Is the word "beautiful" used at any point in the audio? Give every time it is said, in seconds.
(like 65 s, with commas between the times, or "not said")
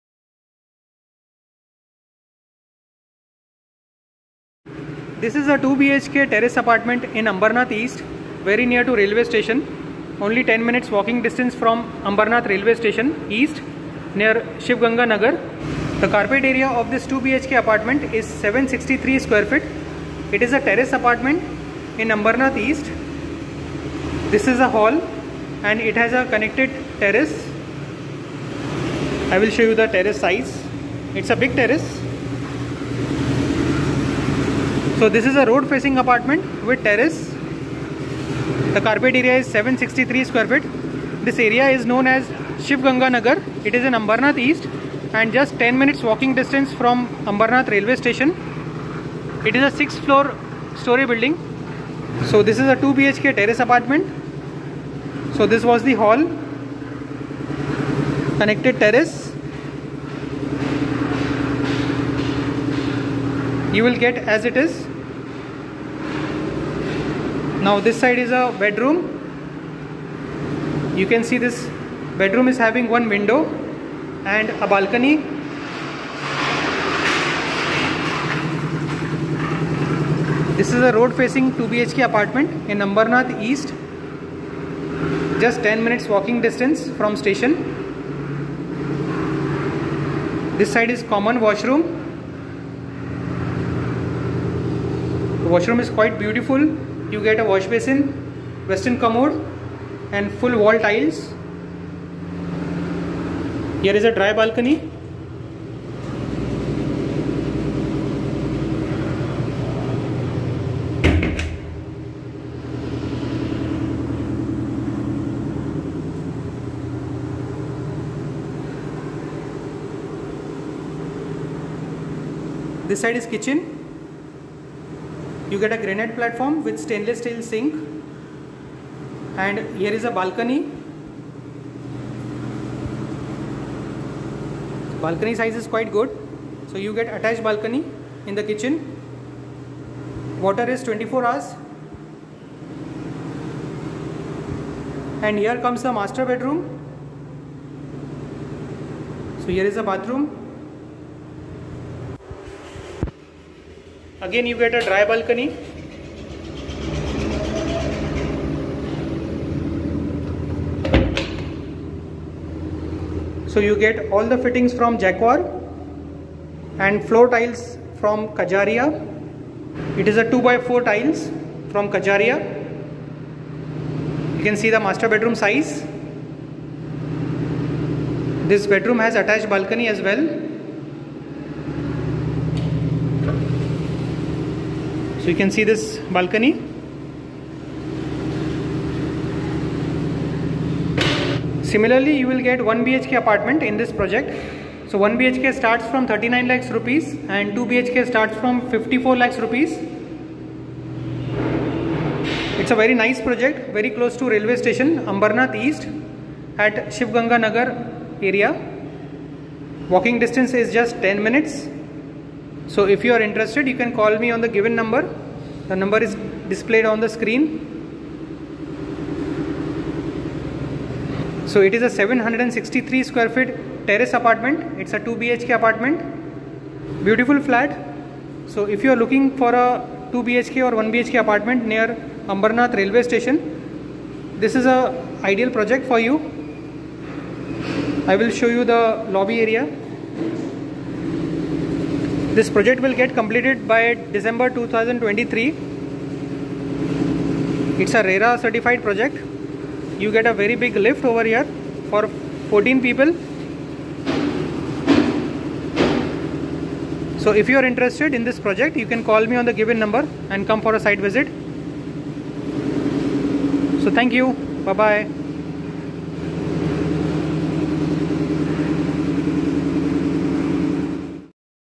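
96 s, 227 s.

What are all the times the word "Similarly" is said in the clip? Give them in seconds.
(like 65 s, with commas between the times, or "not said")
191 s.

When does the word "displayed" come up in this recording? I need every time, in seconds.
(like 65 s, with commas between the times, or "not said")
216 s.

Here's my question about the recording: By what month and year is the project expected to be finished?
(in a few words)
December 2023.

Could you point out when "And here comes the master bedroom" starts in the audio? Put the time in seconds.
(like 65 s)
145 s.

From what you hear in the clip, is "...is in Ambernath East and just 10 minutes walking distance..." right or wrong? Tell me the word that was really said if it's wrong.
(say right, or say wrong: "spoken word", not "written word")
right.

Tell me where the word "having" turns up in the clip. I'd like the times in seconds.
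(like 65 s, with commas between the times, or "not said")
72 s.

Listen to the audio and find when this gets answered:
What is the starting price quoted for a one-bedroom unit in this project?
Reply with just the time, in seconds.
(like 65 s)
196 s.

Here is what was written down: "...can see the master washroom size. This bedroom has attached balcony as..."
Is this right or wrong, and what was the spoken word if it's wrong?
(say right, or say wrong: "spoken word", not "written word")
wrong: "bedroom", not "washroom".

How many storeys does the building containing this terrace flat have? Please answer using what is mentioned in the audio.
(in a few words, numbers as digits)
6.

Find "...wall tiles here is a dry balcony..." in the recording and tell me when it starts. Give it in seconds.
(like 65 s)
100 s.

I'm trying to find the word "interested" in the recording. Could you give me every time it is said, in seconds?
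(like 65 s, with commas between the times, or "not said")
213 s, 257 s.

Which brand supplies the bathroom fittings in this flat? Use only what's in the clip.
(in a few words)
Jaguar.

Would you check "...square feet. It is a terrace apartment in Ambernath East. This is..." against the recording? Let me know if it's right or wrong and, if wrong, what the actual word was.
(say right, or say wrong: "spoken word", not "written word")
right.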